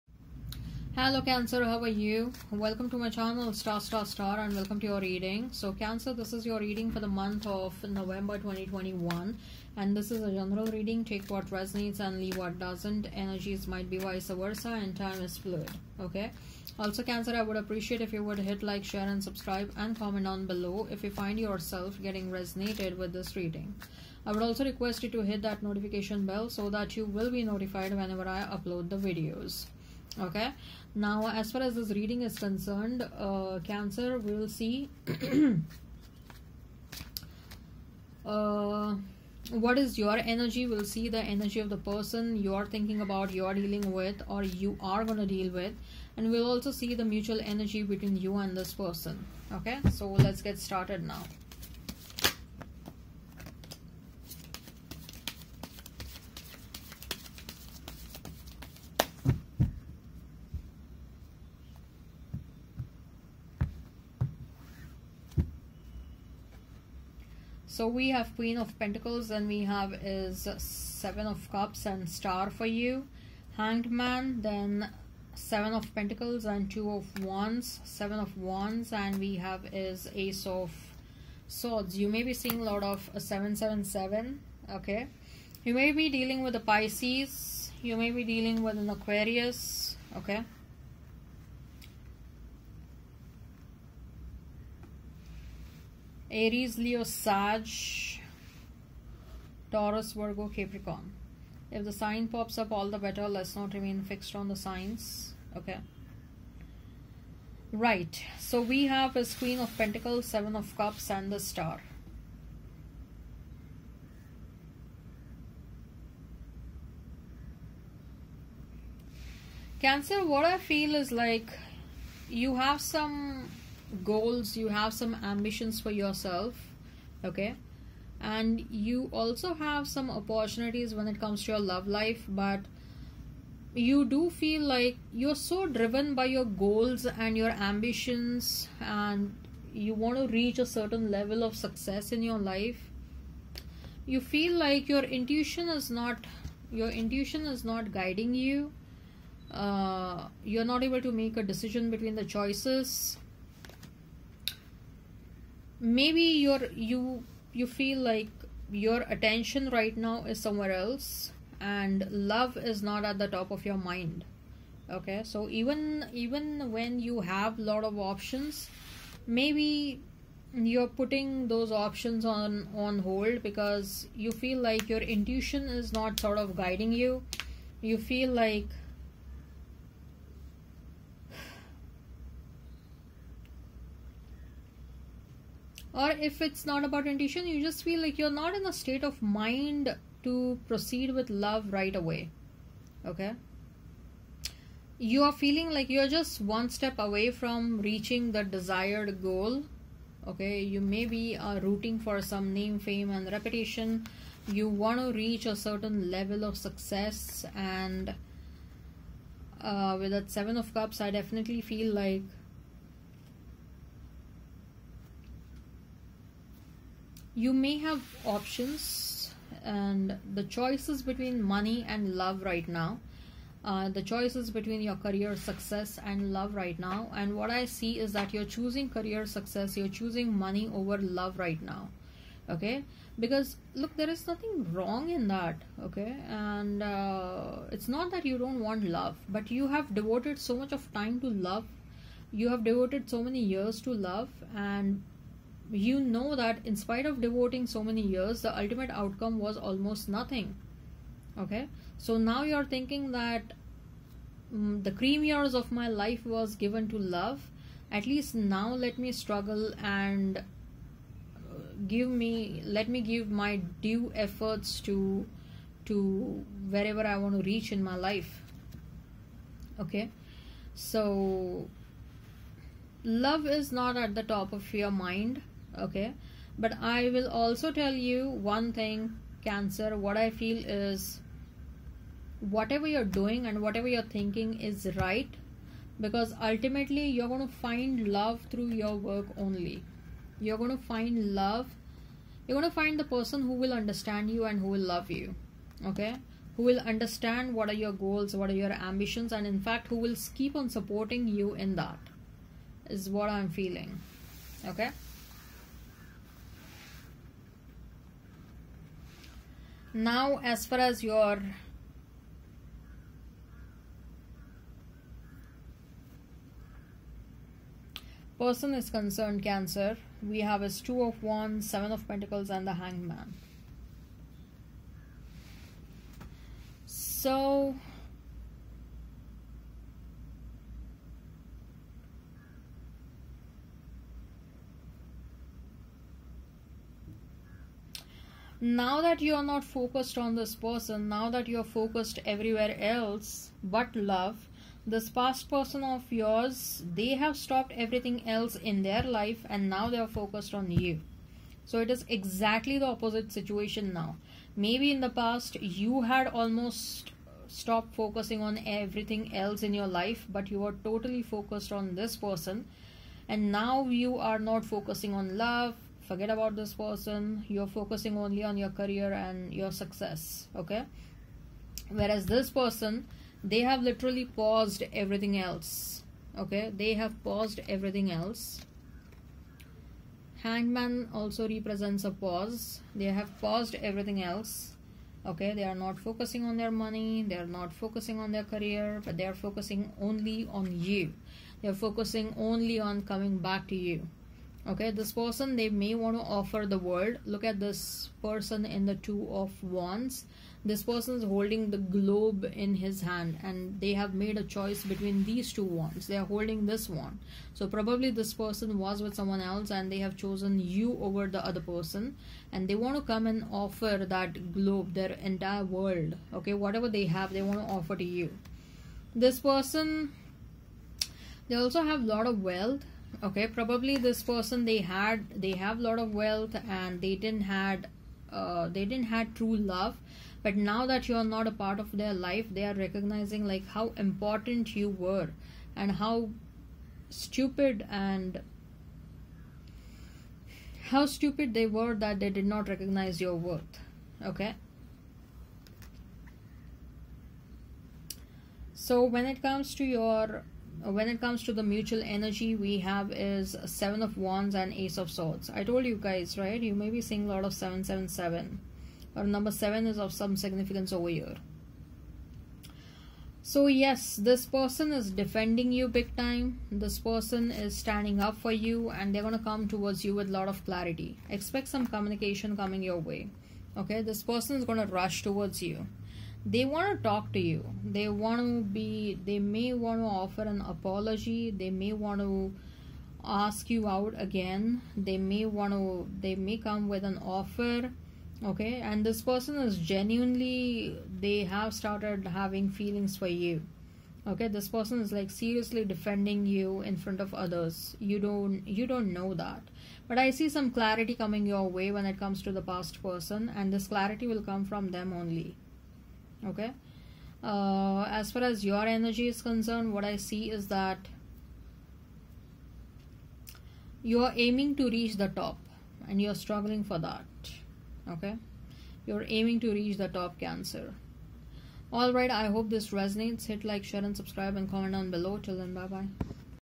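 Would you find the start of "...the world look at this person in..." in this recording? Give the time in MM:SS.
06:36.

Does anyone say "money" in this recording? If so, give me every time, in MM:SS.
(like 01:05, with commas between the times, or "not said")
03:41, 03:50, 06:26.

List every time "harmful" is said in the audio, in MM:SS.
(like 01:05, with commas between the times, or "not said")
not said.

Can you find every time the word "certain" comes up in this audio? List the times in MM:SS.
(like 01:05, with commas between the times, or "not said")
02:20, 03:25.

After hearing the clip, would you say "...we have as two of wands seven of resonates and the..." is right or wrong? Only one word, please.
wrong.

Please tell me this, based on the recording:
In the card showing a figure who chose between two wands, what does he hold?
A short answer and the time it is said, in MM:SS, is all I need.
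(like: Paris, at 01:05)
the globe, at 06:41.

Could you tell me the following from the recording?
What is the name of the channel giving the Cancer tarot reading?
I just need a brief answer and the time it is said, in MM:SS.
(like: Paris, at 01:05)
Staar Staar Staar, at 00:03.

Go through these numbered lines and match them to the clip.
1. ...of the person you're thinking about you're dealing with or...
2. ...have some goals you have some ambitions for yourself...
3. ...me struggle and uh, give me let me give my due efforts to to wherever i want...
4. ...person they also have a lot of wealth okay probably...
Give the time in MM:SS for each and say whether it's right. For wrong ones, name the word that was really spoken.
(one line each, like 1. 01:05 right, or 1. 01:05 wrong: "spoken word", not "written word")
1. 00:41 right
2. 02:02 right
3. 04:18 right
4. 06:59 right.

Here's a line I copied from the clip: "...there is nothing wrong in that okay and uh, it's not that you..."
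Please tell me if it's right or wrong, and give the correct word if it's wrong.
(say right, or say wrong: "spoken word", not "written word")
right.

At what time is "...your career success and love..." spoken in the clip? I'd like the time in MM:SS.
03:44.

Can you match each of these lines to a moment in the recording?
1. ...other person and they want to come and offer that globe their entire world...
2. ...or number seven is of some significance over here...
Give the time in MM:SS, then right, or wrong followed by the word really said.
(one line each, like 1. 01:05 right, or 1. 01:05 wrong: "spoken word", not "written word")
1. 06:51 right
2. 07:39 right.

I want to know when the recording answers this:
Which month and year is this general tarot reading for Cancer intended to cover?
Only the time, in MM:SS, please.
00:07.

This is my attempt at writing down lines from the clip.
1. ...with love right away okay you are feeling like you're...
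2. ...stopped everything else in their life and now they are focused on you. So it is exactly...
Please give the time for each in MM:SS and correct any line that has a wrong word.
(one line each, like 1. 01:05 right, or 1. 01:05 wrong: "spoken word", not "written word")
1. 03:11 right
2. 05:47 right.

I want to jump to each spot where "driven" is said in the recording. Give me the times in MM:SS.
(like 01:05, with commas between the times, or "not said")
02:15.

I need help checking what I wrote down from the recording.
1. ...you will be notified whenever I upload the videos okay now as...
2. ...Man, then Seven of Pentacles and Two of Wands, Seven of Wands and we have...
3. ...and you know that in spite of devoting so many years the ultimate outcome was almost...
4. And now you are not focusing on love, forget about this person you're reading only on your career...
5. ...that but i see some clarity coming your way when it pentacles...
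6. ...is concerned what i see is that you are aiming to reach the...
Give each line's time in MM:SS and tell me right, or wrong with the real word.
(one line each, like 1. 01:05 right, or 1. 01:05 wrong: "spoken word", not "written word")
1. 00:26 right
2. 01:13 right
3. 04:04 right
4. 06:03 wrong: "focusing", not "reading"
5. 08:19 wrong: "comes", not "pentacles"
6. 08:29 right.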